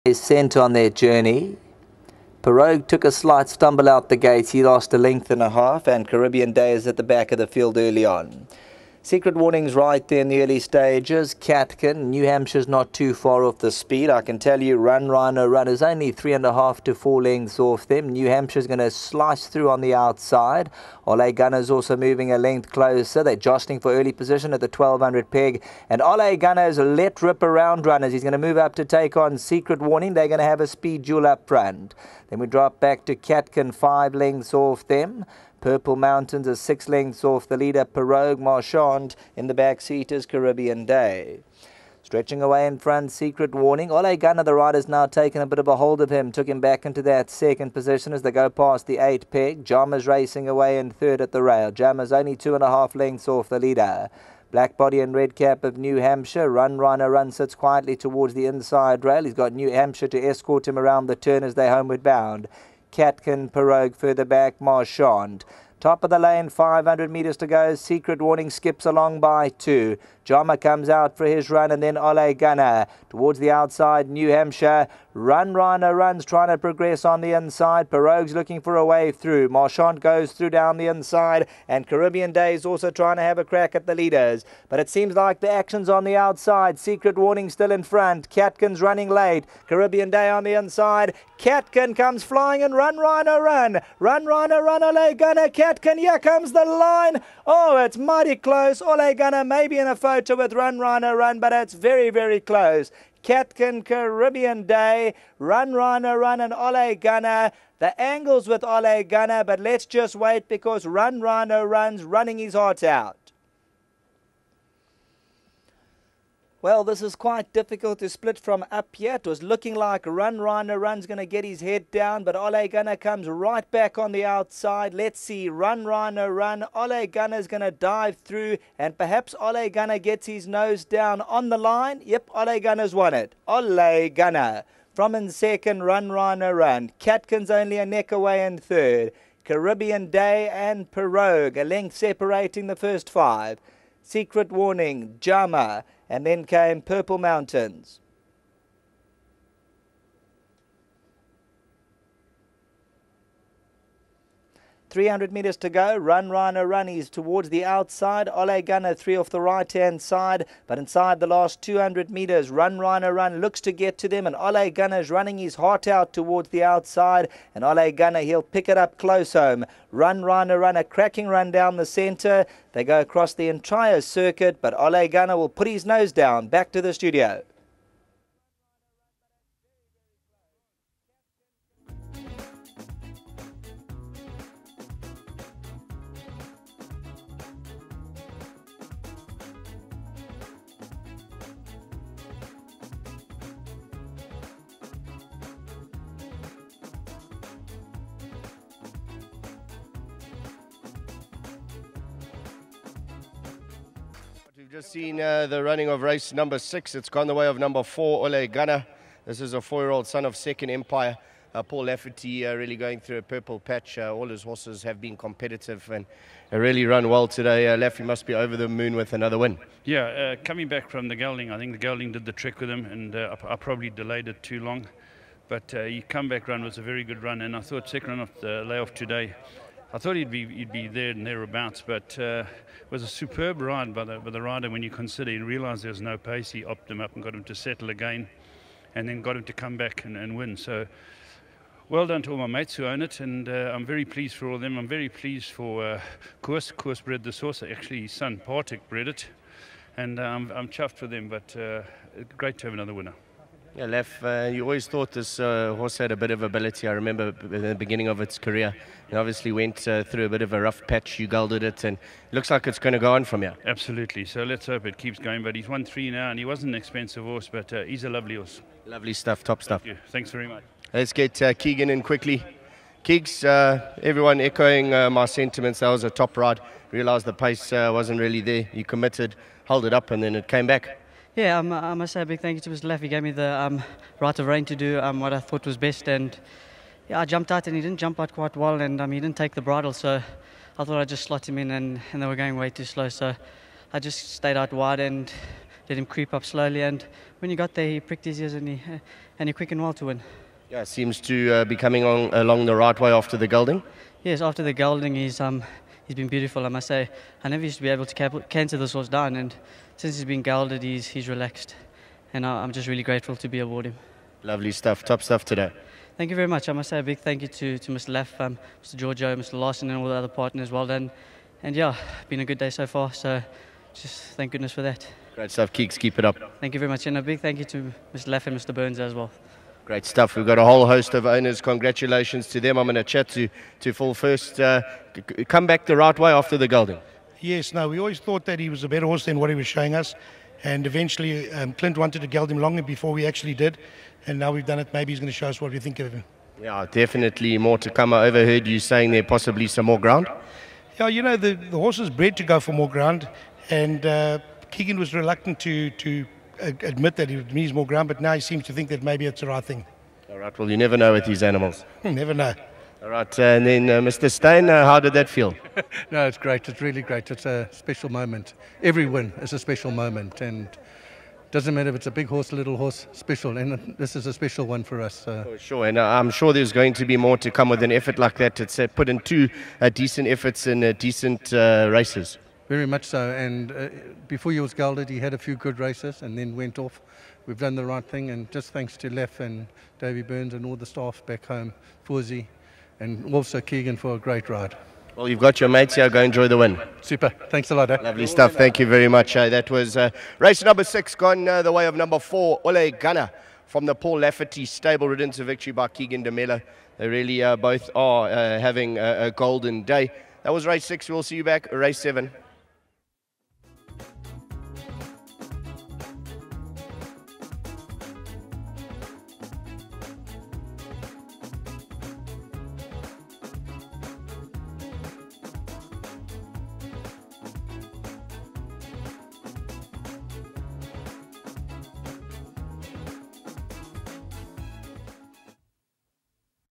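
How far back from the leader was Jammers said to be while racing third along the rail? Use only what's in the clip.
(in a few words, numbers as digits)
2.5 lengths.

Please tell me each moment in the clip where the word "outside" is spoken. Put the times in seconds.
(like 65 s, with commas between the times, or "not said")
19 s, 73 s, 86 s, 124 s, 157 s, 166 s.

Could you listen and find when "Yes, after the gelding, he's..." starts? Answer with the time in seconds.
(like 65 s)
304 s.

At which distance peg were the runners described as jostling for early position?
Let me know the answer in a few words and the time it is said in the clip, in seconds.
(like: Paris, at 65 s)
1200, at 24 s.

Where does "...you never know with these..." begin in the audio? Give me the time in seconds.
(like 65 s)
360 s.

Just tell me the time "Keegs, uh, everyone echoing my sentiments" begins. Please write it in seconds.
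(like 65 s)
273 s.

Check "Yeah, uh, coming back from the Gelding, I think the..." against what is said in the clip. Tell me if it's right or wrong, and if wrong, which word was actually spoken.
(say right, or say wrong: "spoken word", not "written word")
right.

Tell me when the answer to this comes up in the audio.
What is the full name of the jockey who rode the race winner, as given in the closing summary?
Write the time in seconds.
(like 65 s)
405 s.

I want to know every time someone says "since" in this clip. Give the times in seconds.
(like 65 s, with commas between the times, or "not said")
309 s.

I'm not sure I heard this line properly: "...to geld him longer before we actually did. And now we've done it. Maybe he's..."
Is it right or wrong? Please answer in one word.
right.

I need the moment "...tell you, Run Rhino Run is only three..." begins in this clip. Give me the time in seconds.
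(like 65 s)
14 s.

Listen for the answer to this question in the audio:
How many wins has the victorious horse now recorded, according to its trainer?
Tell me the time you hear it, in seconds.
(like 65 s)
265 s.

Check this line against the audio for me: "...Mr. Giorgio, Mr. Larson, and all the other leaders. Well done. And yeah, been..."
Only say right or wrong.
wrong.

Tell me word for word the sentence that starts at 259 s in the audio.
It obviously went uh, through a bit of a rough patch.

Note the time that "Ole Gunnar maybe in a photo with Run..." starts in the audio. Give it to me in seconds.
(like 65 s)
98 s.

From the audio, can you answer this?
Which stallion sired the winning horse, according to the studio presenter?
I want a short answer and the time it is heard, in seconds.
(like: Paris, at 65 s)
Second Empire, at 210 s.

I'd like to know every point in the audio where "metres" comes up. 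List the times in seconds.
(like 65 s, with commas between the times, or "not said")
67 s, 155 s, 162 s.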